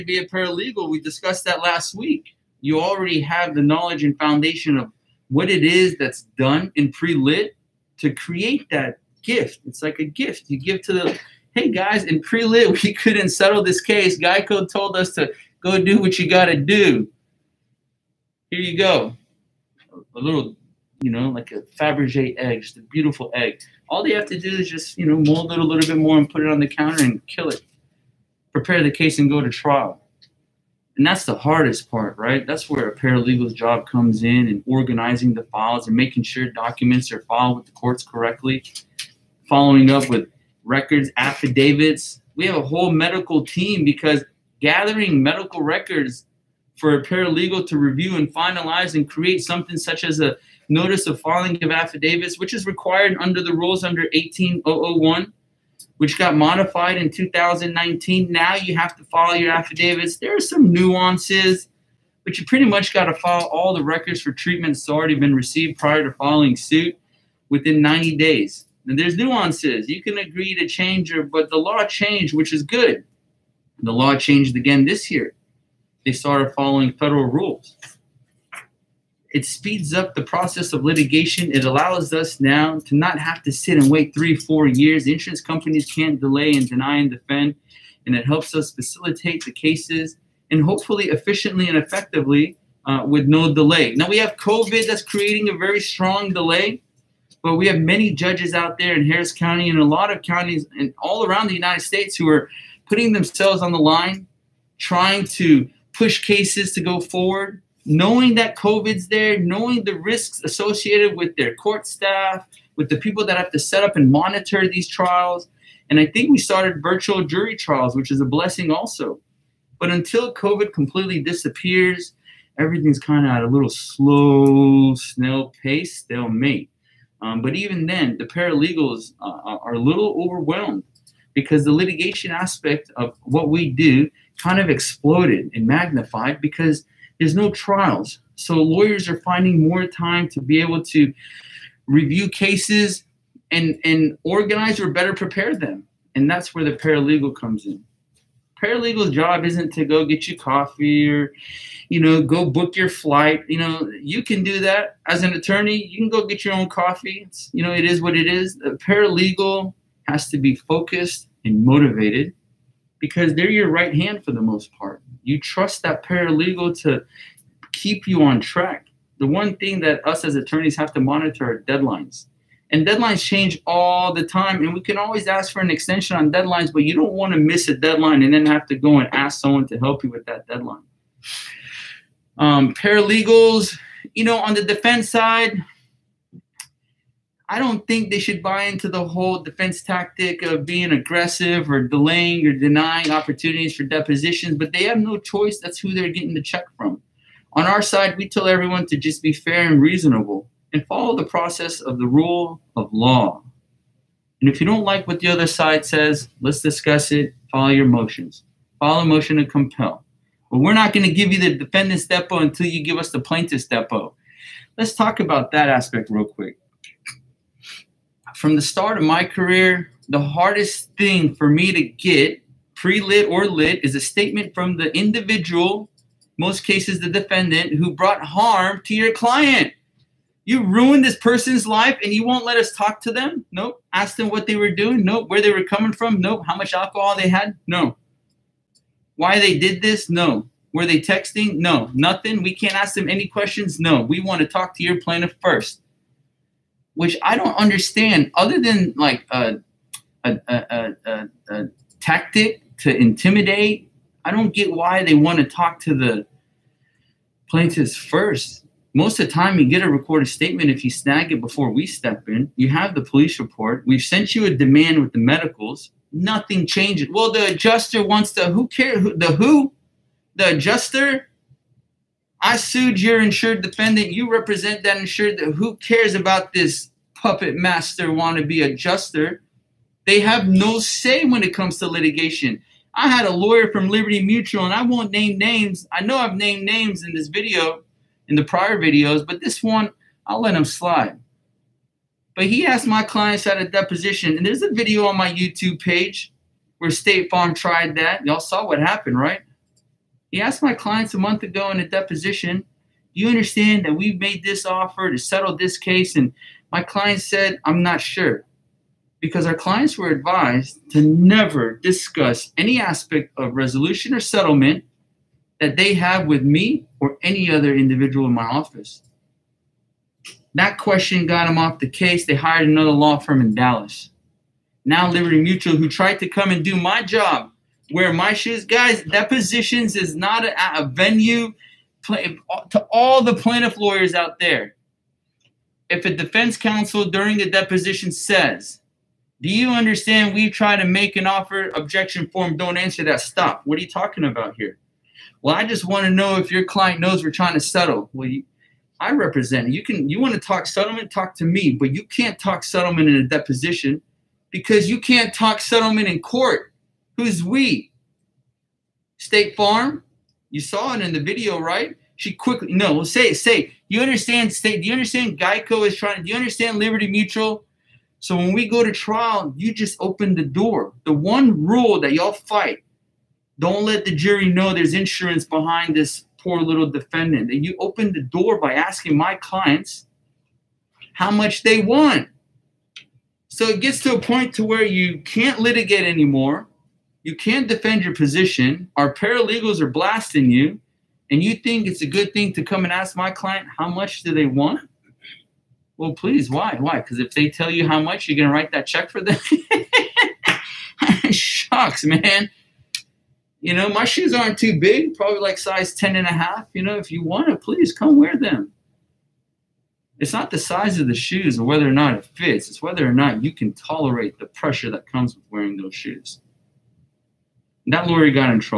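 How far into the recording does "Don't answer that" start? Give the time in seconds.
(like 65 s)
342 s.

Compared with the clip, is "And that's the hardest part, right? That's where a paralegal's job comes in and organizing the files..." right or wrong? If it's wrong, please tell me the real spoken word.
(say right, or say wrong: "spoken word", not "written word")
right.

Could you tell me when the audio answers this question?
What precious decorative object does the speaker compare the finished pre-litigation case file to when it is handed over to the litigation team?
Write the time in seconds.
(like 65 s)
21 s.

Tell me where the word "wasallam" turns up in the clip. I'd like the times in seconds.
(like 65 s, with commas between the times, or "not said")
not said.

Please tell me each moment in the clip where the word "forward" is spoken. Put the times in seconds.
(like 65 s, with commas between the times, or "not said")
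106 s.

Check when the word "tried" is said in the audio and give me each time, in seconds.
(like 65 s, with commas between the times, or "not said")
297 s, 325 s.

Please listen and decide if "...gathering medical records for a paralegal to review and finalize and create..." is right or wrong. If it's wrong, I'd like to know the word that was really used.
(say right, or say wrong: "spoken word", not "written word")
right.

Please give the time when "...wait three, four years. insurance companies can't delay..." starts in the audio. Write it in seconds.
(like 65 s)
83 s.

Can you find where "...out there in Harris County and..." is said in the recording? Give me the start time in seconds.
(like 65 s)
98 s.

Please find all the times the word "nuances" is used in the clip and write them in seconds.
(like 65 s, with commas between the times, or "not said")
60 s, 69 s.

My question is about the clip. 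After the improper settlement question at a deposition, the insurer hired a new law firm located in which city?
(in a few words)
Dallas.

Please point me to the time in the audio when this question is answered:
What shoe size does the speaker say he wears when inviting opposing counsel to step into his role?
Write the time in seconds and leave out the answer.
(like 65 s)
405 s.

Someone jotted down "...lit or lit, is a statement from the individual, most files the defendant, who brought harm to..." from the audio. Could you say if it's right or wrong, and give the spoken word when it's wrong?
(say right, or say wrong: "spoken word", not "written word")
wrong: "cases", not "files".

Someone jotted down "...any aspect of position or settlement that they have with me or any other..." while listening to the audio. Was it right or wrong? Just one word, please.
wrong.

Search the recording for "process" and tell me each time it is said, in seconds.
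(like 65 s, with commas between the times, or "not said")
80 s, 201 s.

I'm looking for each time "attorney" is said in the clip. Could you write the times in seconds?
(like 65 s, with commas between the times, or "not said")
155 s, 170 s.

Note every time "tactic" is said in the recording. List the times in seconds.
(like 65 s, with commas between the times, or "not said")
189 s, 252 s.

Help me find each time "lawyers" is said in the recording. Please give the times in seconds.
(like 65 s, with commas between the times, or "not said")
138 s, 283 s, 333 s, 418 s.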